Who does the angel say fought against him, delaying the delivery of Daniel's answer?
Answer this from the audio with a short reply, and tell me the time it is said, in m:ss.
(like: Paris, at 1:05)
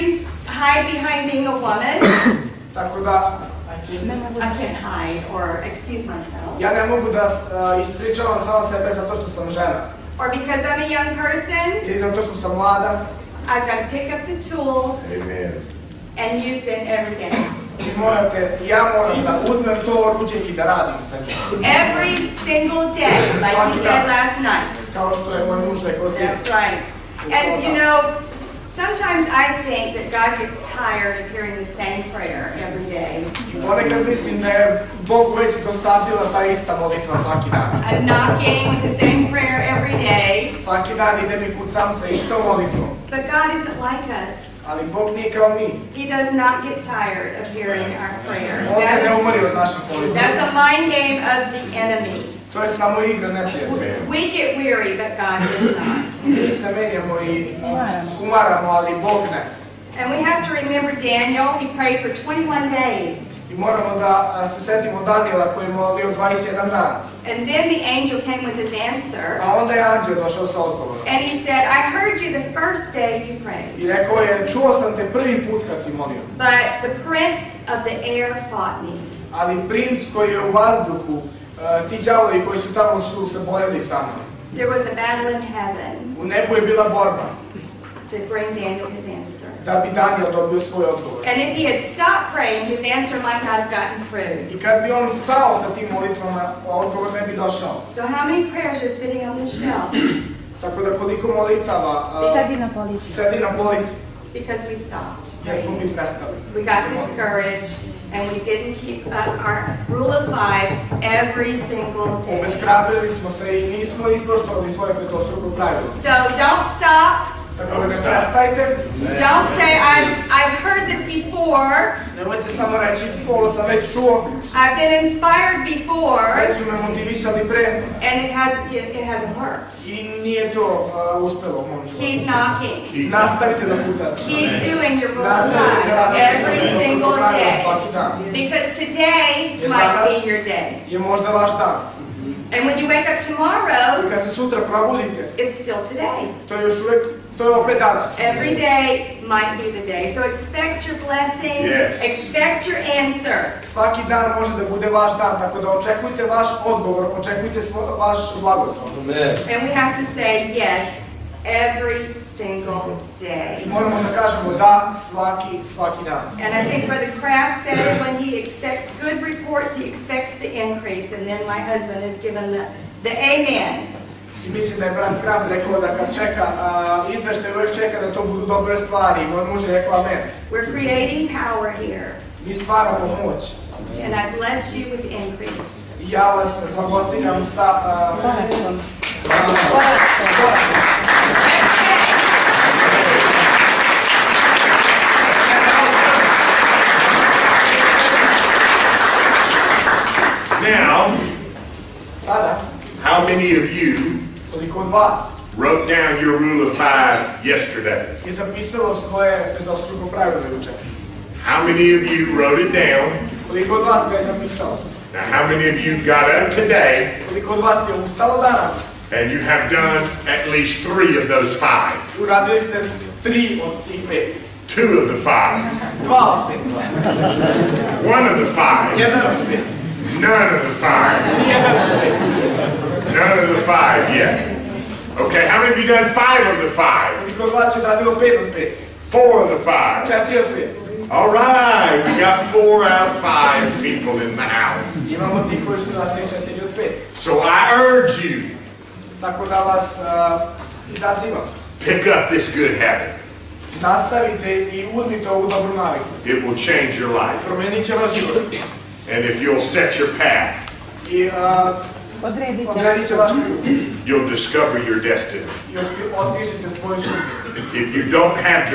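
the prince of the air, at 1:16.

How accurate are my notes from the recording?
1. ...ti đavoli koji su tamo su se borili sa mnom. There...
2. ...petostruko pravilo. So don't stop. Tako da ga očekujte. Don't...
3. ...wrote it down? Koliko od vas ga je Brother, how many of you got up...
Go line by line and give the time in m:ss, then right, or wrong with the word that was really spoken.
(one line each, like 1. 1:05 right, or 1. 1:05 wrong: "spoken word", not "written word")
1. 1:21 right
2. 1:54 wrong: "prestajte", not "očekujte"
3. 3:32 wrong: "Now", not "Brother".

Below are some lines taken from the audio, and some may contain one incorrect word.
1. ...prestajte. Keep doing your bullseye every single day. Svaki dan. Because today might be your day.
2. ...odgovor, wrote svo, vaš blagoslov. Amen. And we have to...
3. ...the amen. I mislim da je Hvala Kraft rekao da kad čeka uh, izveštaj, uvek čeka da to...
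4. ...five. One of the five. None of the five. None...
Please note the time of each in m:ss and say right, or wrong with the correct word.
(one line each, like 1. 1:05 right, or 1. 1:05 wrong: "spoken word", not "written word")
1. 2:13 wrong: "pucate", not "prestajte"
2. 2:36 wrong: "očekujte", not "wrote"
3. 2:53 wrong: "Brand", not "Hvala"
4. 3:45 right.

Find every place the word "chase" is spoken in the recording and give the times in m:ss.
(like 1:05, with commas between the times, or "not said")
not said.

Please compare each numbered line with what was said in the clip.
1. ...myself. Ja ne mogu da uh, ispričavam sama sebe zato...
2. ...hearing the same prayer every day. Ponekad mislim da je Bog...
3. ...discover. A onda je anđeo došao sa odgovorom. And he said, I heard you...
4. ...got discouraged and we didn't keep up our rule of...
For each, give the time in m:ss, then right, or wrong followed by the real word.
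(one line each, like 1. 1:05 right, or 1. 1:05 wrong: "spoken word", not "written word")
1. 0:06 right
2. 0:31 right
3. 1:08 wrong: "answer", not "discover"
4. 1:46 right.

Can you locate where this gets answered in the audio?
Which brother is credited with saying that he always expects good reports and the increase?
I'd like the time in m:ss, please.
2:46.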